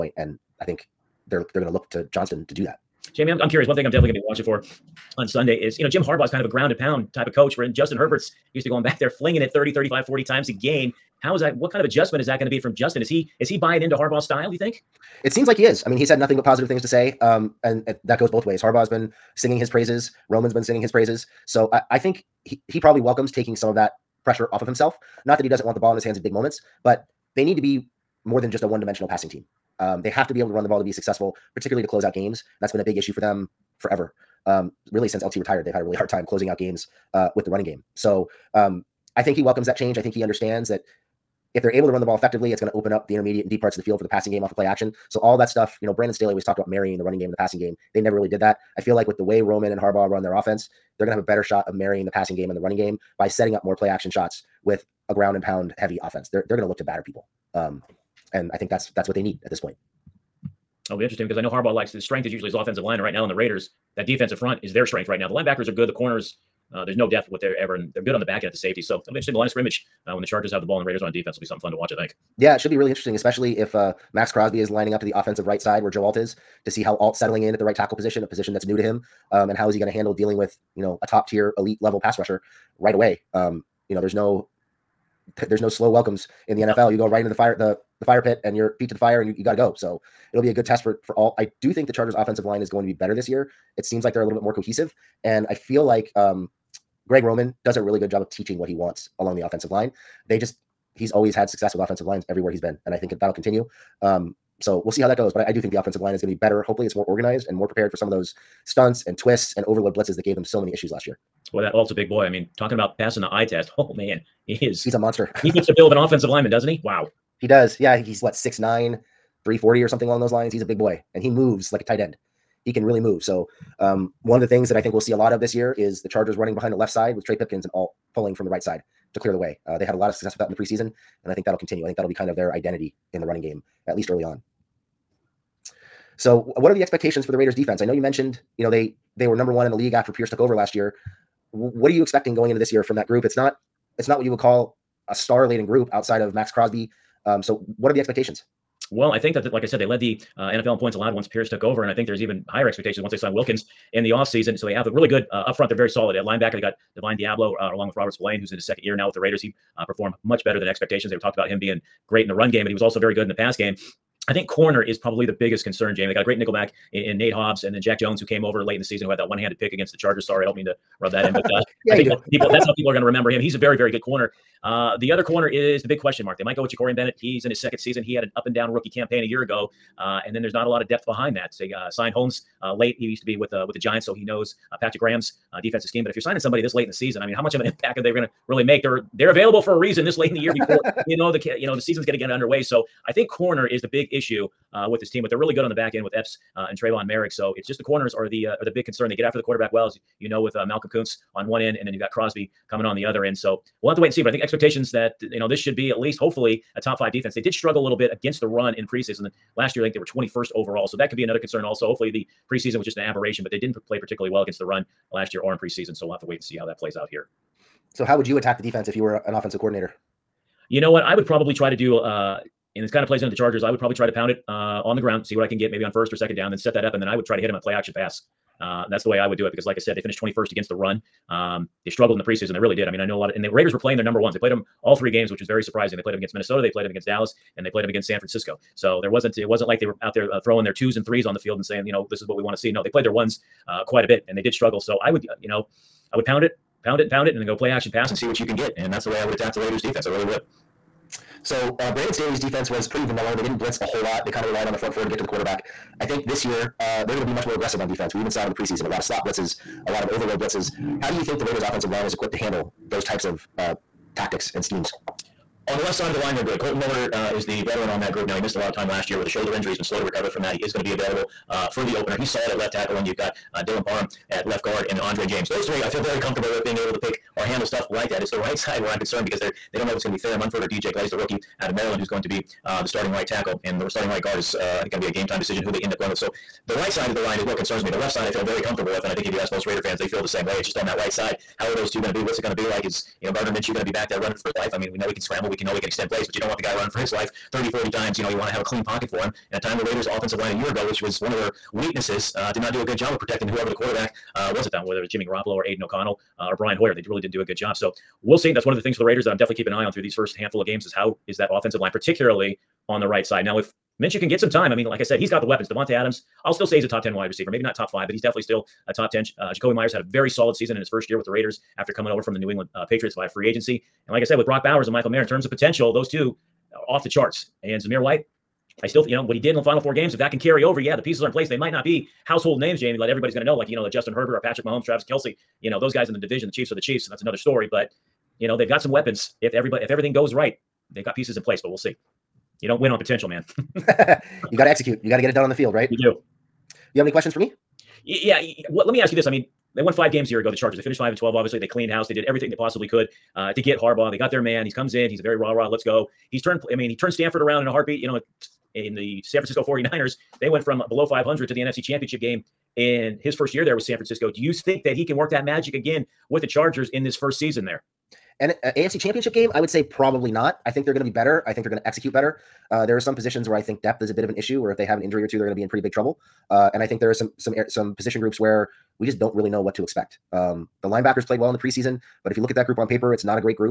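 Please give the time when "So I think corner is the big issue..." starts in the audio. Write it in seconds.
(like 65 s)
192 s.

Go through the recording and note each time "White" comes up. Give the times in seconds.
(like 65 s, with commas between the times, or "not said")
328 s.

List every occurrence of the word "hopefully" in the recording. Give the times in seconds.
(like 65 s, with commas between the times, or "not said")
106 s, 206 s, 211 s.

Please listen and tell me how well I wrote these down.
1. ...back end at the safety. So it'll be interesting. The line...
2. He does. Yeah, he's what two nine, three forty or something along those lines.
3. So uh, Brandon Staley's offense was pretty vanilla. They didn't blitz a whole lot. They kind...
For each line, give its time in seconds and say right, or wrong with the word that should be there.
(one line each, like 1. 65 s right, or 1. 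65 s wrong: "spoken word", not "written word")
1. 68 s right
2. 117 s wrong: "six", not "two"
3. 251 s wrong: "defense", not "offense".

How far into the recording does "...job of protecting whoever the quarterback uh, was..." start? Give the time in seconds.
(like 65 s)
302 s.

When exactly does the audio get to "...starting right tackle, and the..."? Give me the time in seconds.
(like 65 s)
282 s.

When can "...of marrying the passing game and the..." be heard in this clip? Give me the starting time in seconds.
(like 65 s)
51 s.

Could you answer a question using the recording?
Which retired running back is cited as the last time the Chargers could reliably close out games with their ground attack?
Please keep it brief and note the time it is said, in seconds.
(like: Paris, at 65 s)
LT, at 35 s.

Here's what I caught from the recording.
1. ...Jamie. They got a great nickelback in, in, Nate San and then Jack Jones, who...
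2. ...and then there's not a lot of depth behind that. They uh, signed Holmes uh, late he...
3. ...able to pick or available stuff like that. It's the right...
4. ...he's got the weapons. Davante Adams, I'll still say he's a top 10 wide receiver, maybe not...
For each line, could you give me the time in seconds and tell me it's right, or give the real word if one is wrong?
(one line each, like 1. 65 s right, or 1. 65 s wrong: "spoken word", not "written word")
1. 165 s wrong: "Hobbs", not "San"
2. 180 s right
3. 276 s wrong: "handle", not "available"
4. 315 s right.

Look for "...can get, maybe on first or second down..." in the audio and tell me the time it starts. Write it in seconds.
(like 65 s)
225 s.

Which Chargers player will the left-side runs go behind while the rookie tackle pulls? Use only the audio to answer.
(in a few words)
Trey Pipkins.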